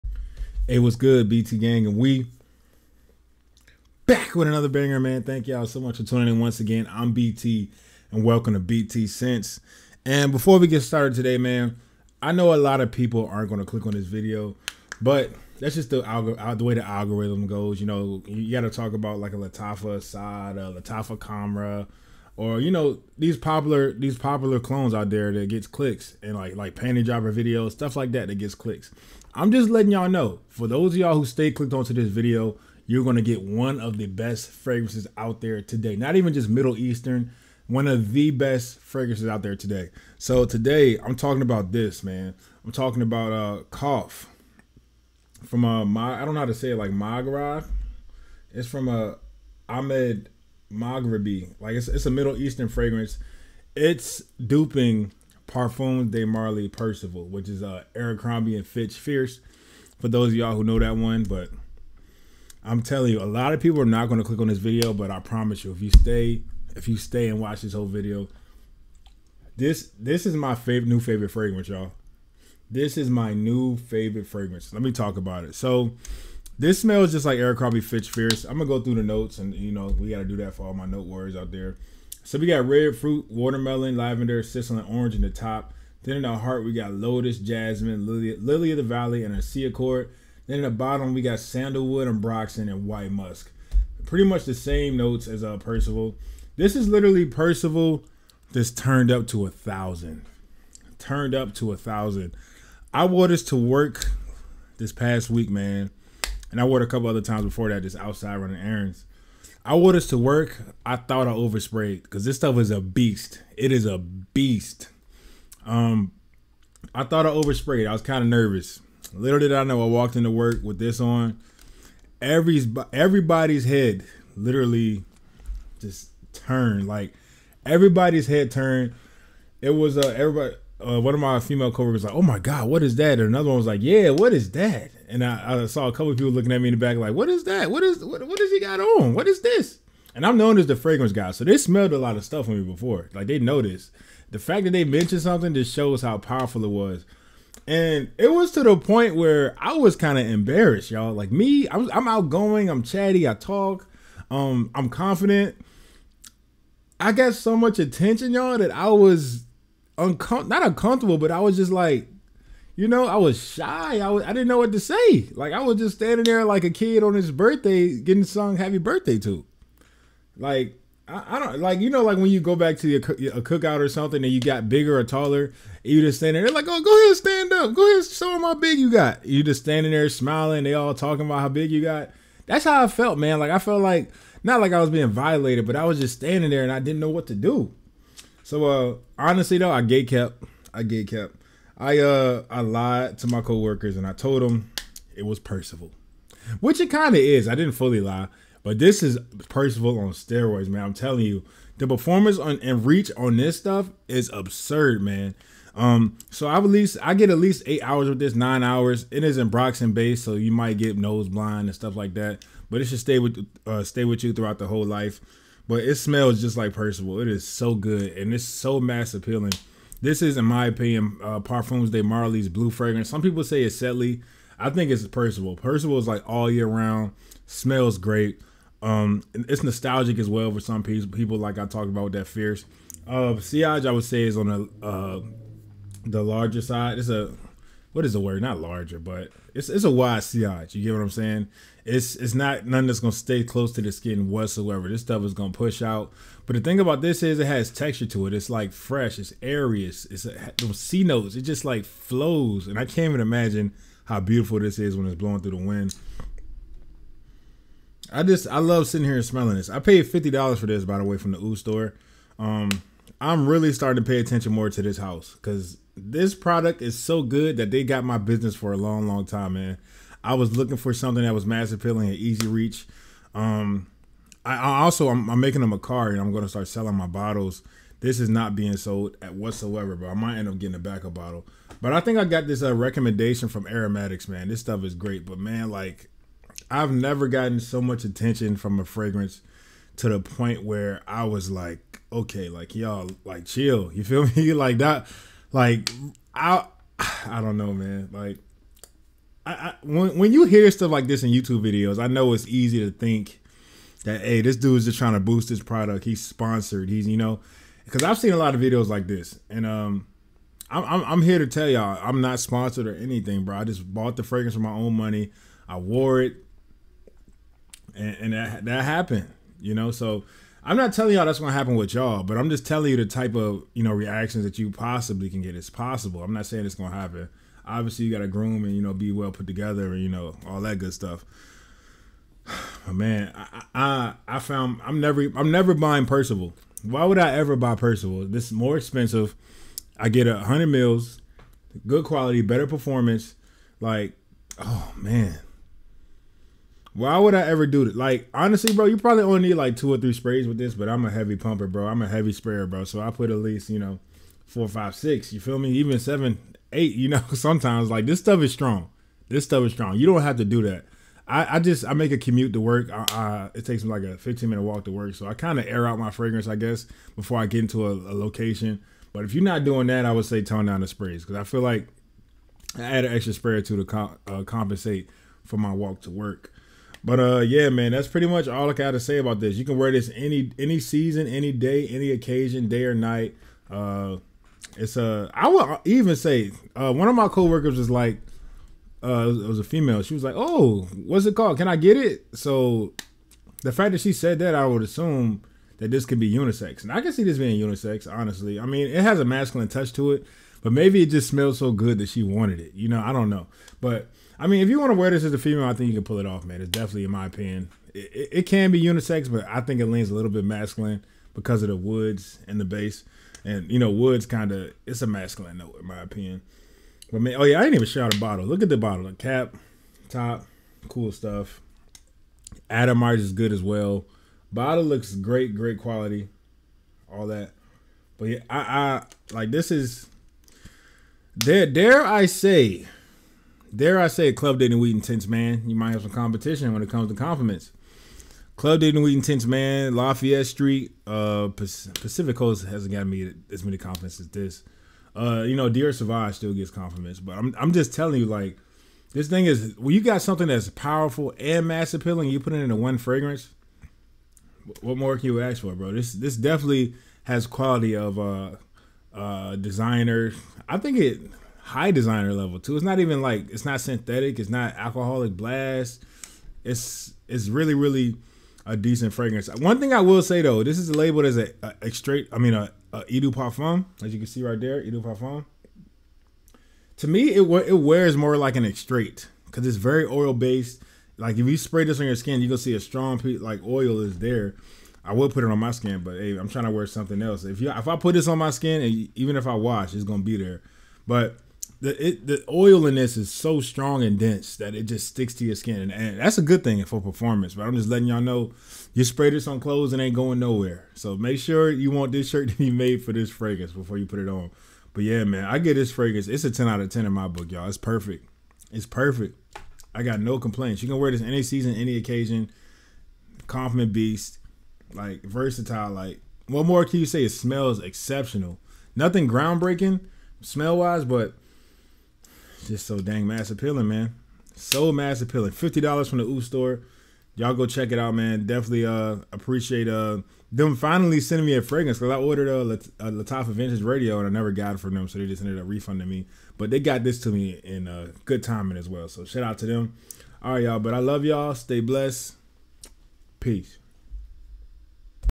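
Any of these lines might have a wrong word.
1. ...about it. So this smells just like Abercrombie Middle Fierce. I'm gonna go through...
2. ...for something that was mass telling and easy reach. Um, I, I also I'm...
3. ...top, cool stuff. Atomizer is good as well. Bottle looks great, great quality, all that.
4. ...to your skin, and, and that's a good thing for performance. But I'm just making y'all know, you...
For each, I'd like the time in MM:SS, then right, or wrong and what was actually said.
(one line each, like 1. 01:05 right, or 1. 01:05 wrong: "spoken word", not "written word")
1. 01:15 wrong: "Fitch", not "Middle"
2. 04:30 wrong: "appealing", not "telling"
3. 07:00 right
4. 08:15 wrong: "letting", not "making".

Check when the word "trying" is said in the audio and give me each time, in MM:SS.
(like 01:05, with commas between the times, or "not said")
05:04, 08:06.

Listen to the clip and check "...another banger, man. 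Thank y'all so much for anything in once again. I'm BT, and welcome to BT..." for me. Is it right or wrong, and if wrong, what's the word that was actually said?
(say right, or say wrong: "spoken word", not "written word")
wrong: "tuning", not "anything".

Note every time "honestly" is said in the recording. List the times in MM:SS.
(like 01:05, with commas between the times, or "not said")
03:09, 05:48, 06:38.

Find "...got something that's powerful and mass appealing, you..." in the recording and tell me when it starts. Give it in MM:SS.
07:29.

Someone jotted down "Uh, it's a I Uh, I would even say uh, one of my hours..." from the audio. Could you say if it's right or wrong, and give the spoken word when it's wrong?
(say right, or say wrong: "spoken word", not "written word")
wrong: "coworkers", not "hours".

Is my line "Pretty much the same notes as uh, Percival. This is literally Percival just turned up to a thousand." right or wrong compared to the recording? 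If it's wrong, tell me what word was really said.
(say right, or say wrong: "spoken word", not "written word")
right.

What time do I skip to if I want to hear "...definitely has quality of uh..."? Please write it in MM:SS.
07:36.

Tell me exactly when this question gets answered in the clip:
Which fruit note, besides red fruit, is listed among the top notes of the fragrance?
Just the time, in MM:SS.
01:23.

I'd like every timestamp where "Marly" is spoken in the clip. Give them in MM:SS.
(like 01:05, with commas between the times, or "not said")
00:56, 03:42.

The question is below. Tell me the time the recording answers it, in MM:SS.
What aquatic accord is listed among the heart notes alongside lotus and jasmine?
01:29.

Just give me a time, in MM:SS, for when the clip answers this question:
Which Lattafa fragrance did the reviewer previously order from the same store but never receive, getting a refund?
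08:53.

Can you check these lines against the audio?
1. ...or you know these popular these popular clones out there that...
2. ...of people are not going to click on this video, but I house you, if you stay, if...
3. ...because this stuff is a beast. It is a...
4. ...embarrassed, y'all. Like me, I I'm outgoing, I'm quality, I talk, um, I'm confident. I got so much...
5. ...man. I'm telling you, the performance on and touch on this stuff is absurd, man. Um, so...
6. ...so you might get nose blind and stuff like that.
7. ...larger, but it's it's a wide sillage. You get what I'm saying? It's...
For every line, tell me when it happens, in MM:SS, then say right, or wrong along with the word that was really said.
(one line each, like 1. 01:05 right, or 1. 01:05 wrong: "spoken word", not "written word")
1. 00:22 right
2. 01:03 wrong: "promise", not "house"
3. 01:52 right
4. 02:30 wrong: "chatty", not "quality"
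5. 03:20 wrong: "reach", not "touch"
6. 03:30 right
7. 03:58 right.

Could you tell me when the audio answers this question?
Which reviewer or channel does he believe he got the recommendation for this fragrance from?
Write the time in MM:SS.
04:43.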